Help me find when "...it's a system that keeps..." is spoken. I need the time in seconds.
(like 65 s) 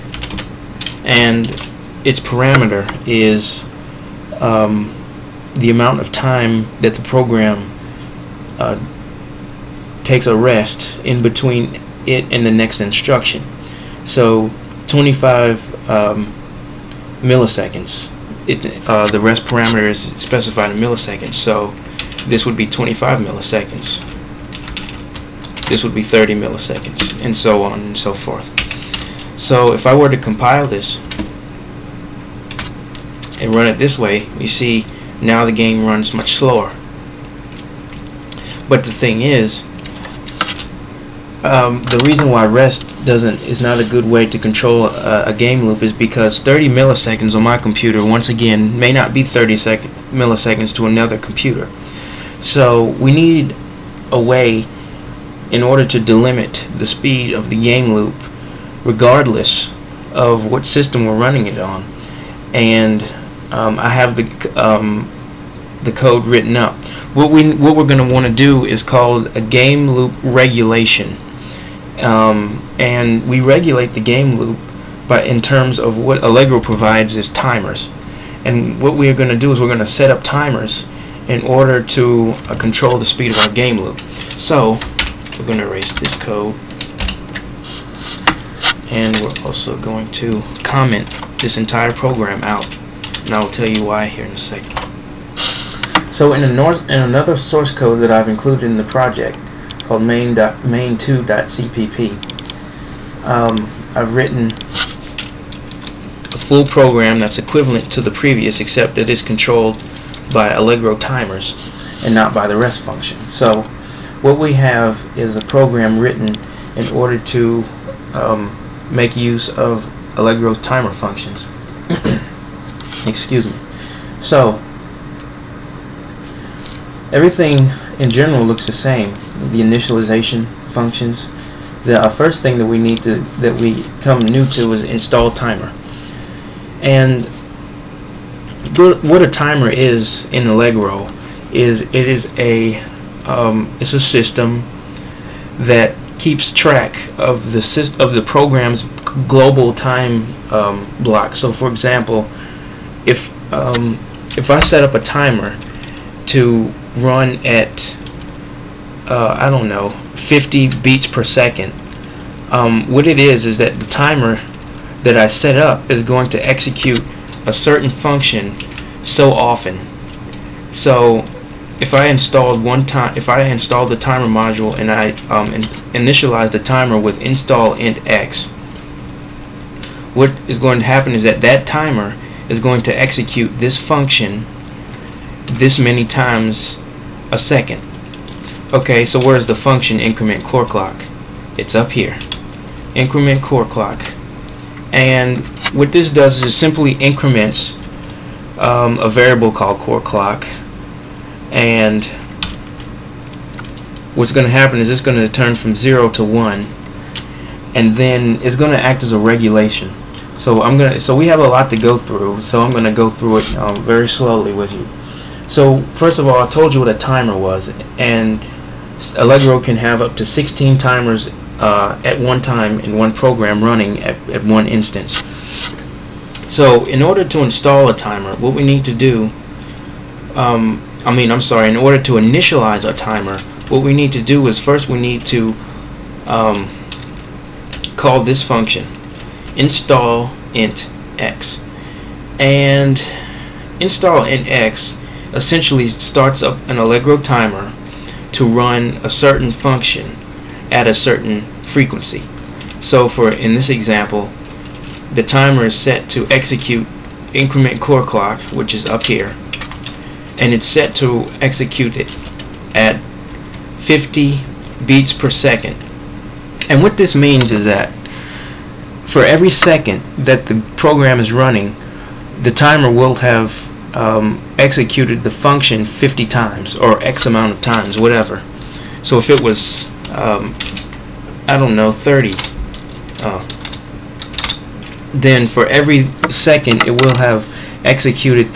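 143 s.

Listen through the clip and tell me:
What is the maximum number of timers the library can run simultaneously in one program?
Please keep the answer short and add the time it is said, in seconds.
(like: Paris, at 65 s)
16, at 220 s.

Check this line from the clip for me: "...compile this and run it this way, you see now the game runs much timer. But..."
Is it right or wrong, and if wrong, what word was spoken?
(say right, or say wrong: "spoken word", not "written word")
wrong: "slower", not "timer".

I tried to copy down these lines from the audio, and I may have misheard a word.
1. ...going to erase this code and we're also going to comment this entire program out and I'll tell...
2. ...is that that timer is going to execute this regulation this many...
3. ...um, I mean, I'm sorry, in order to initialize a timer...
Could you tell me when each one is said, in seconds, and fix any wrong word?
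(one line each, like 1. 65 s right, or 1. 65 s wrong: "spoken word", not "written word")
1. 85 s right
2. 181 s wrong: "function", not "regulation"
3. 230 s right.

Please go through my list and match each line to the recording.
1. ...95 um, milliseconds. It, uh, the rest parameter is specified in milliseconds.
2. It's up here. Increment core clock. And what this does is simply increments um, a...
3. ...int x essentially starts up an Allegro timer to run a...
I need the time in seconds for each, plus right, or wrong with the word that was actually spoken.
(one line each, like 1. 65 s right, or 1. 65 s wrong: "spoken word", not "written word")
1. 14 s wrong: "25", not "95"
2. 191 s right
3. 244 s right.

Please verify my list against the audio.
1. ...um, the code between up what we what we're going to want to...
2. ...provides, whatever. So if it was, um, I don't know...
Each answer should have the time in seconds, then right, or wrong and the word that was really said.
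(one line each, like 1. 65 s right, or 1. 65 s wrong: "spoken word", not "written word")
1. 64 s wrong: "written", not "between"
2. 277 s wrong: "times", not "provides".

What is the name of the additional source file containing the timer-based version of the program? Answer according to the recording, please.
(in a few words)
main2.cpp.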